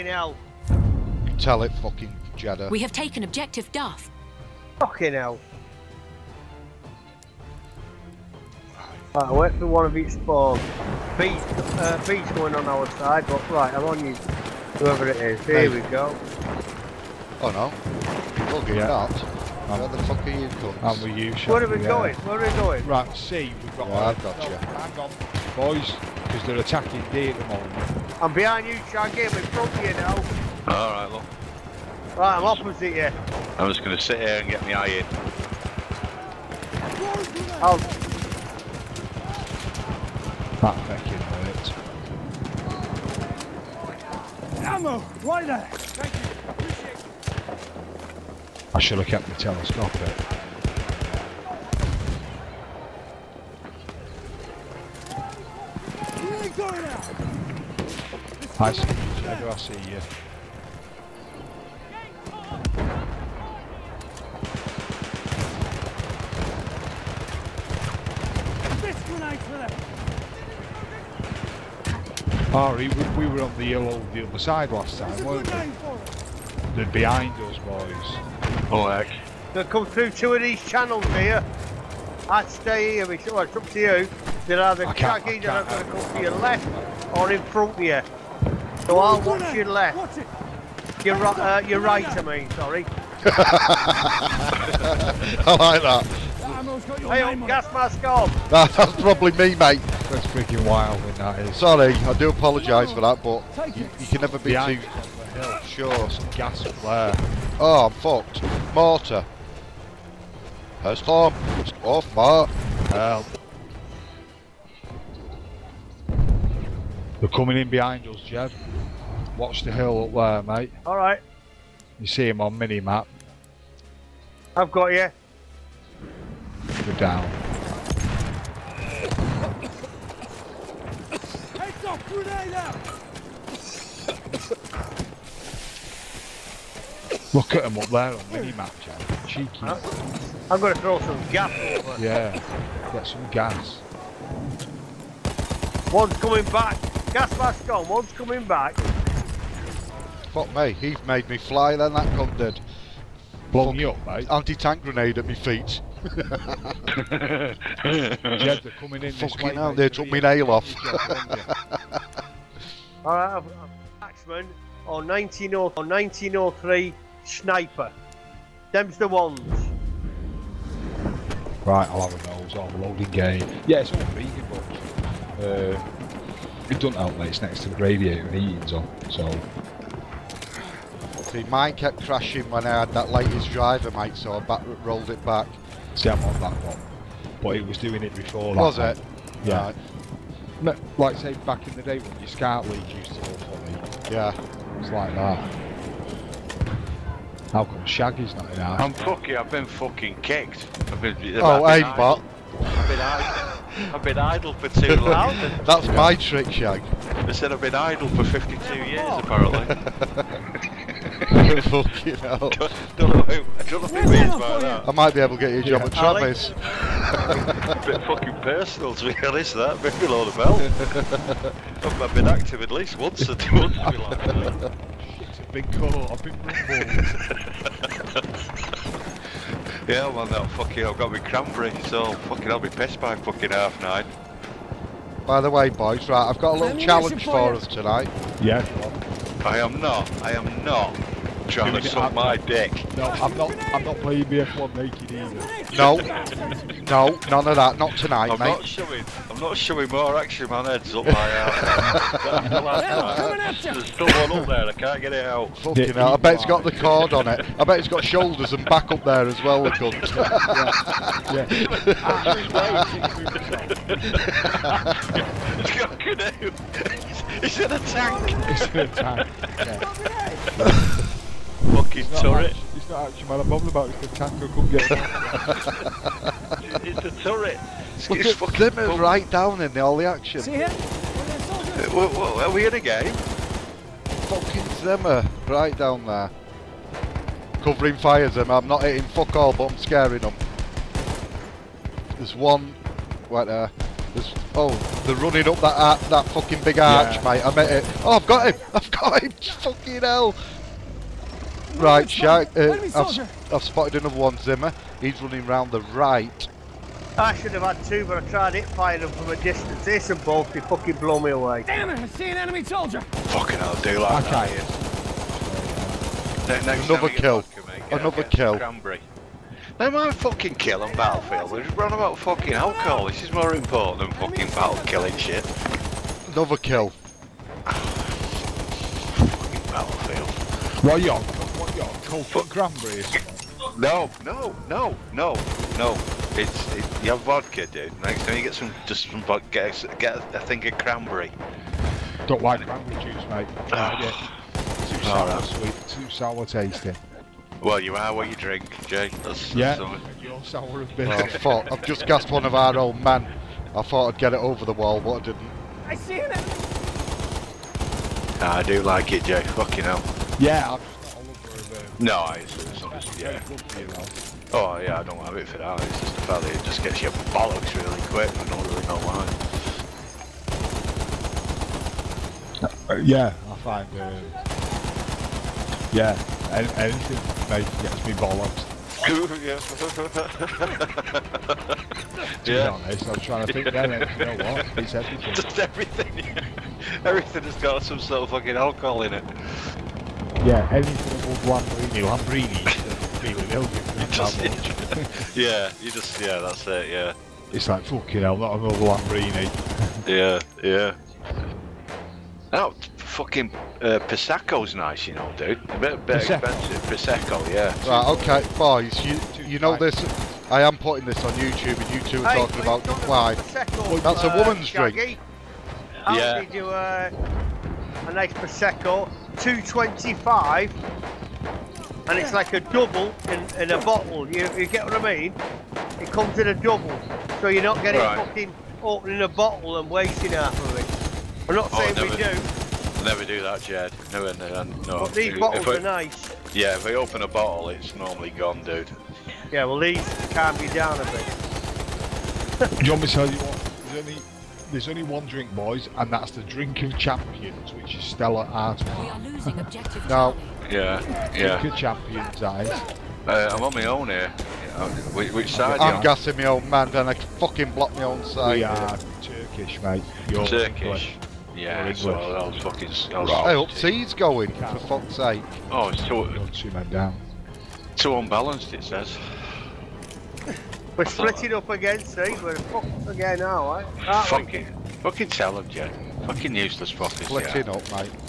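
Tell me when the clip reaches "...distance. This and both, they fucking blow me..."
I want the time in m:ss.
5:09.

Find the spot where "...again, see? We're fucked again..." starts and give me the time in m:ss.
7:51.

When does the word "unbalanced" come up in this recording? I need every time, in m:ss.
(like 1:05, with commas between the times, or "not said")
7:48.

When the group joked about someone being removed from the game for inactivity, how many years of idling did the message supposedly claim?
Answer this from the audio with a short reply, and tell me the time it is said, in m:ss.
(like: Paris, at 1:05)
52, at 3:28.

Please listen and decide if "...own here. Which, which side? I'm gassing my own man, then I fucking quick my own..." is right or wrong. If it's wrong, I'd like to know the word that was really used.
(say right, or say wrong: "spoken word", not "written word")
wrong: "block", not "quick".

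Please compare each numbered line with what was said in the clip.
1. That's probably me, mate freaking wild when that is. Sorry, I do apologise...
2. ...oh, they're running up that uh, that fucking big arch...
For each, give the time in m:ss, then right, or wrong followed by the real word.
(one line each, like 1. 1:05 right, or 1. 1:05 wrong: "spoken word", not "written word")
1. 1:38 right
2. 4:54 right.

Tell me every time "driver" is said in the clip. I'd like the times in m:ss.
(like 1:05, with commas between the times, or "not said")
3:03.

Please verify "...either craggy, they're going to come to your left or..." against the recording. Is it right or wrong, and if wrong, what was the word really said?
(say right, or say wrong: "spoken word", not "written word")
right.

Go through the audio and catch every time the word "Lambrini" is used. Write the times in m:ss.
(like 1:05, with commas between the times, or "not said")
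6:32, 6:38.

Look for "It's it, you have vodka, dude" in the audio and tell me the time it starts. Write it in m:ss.
5:36.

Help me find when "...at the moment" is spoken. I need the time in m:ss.
0:27.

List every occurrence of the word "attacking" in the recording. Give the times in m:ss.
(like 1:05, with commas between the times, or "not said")
0:26.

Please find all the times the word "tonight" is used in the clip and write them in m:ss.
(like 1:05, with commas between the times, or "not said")
3:57, 4:07.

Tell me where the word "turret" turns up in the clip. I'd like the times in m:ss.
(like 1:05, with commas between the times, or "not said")
4:32, 4:37.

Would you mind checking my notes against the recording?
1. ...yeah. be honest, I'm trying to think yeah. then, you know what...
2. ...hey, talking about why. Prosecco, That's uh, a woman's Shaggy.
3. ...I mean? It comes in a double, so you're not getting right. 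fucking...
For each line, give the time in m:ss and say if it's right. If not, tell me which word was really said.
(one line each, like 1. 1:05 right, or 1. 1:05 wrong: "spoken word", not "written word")
1. 6:22 right
2. 6:52 right
3. 7:04 right.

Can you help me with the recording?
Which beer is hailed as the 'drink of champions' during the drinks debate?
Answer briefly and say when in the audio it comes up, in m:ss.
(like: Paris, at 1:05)
Stella Artois, at 7:28.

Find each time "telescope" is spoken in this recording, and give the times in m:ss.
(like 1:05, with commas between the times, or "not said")
0:49.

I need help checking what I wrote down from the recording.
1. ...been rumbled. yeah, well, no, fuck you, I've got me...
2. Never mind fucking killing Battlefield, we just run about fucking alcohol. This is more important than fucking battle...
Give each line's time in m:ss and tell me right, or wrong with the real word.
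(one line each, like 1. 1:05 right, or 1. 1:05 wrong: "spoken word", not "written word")
1. 3:46 right
2. 5:19 right.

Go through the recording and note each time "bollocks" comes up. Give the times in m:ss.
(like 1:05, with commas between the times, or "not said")
6:07, 6:18.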